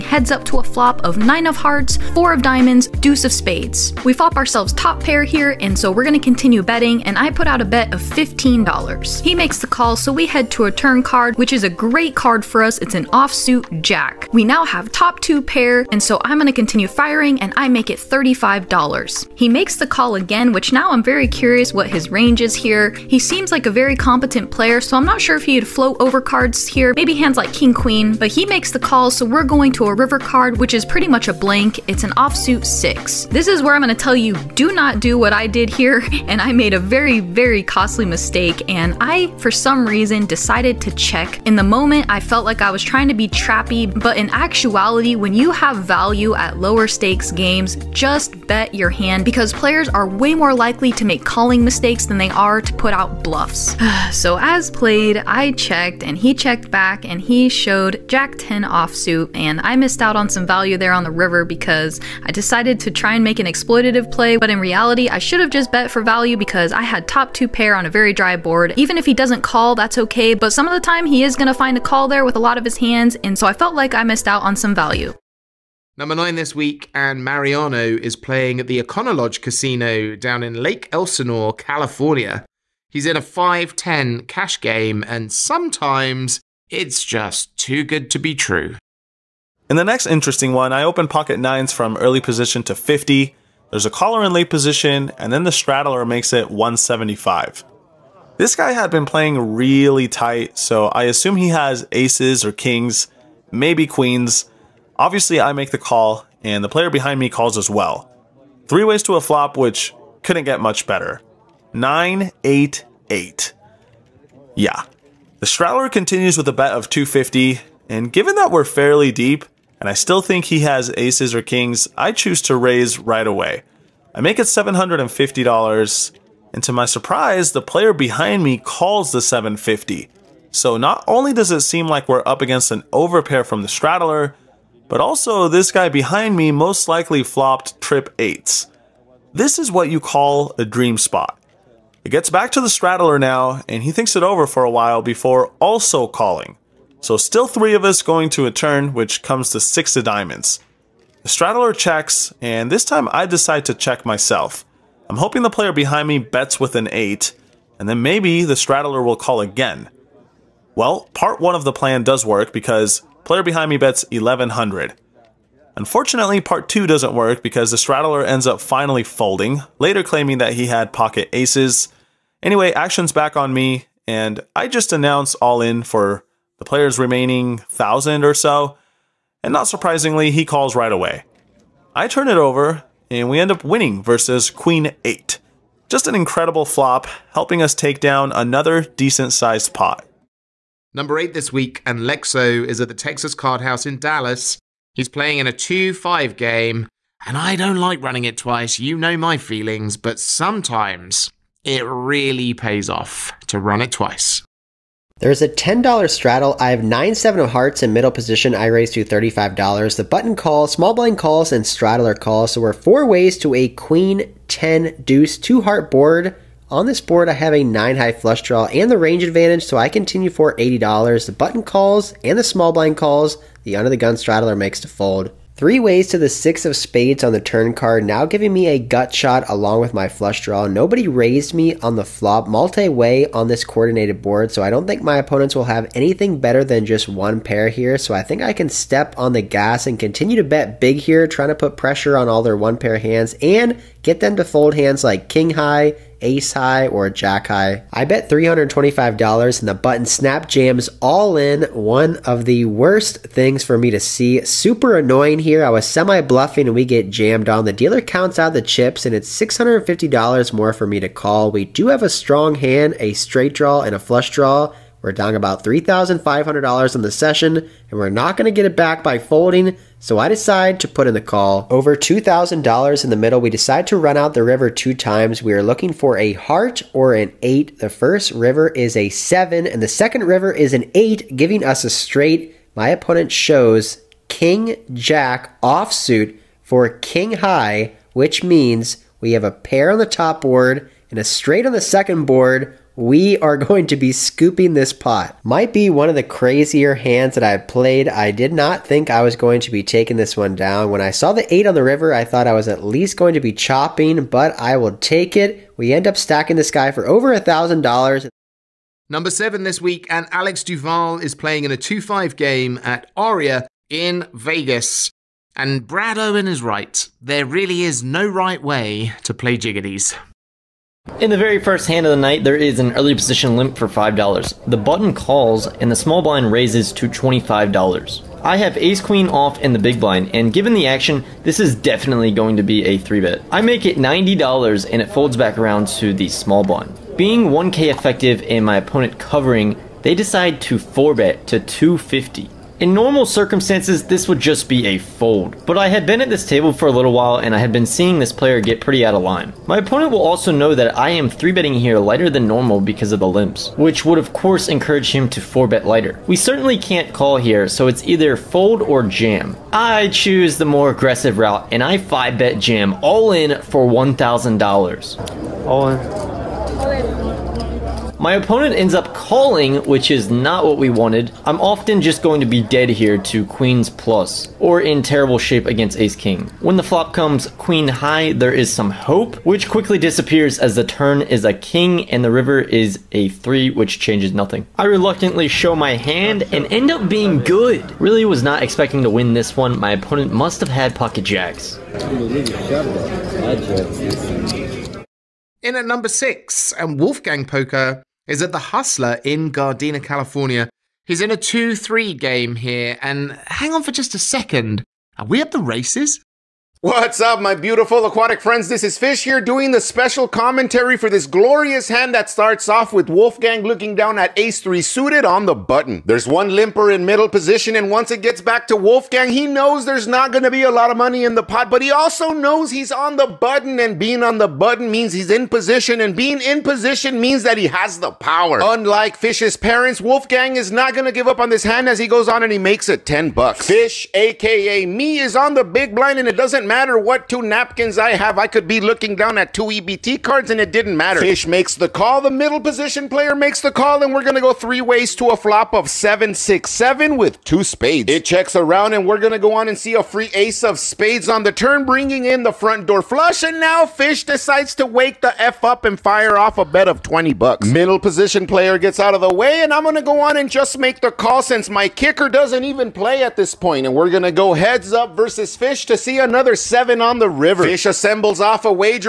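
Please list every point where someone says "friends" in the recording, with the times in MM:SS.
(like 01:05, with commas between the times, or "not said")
06:48.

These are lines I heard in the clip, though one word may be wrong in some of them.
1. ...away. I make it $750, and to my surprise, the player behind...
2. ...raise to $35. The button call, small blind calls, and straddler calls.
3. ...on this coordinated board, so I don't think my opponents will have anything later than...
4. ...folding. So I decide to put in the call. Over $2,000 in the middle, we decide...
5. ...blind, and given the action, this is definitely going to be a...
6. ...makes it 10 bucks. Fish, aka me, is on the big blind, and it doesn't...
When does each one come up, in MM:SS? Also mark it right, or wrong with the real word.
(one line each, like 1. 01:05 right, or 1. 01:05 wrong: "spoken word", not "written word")
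1. 02:03 right
2. 03:28 right
3. 03:53 wrong: "better", not "later"
4. 04:29 right
5. 05:30 right
6. 07:12 right.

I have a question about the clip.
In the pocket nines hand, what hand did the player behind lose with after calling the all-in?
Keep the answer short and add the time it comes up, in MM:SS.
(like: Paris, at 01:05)
Queen 8, at 03:04.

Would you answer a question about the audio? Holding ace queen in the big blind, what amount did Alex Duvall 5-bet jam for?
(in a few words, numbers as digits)
$1,000.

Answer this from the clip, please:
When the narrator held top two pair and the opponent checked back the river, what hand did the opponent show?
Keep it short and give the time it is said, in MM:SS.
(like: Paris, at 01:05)
Jack 10 offsuit, at 00:58.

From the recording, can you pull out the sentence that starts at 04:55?
Might be one of the crazier hands that I've played.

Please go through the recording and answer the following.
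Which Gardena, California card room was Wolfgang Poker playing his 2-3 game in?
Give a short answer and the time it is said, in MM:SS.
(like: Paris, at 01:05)
the Hustler, at 06:38.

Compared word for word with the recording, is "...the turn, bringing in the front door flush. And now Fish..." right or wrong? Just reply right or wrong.
right.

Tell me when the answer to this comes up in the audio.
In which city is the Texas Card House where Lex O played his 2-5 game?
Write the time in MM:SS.
03:13.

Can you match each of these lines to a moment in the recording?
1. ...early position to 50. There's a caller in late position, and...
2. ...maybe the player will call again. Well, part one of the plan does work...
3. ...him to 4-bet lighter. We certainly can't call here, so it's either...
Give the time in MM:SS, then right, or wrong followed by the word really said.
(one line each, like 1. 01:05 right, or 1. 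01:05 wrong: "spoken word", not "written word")
1. 01:31 right
2. 02:38 wrong: "straddler", not "player"
3. 05:55 right.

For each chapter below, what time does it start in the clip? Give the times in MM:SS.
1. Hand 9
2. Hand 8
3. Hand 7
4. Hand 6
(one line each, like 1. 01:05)
1. 01:14
2. 03:09
3. 05:08
4. 06:34.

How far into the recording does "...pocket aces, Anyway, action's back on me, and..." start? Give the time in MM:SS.
02:50.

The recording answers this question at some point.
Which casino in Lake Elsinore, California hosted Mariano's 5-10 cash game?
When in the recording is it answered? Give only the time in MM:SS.
01:18.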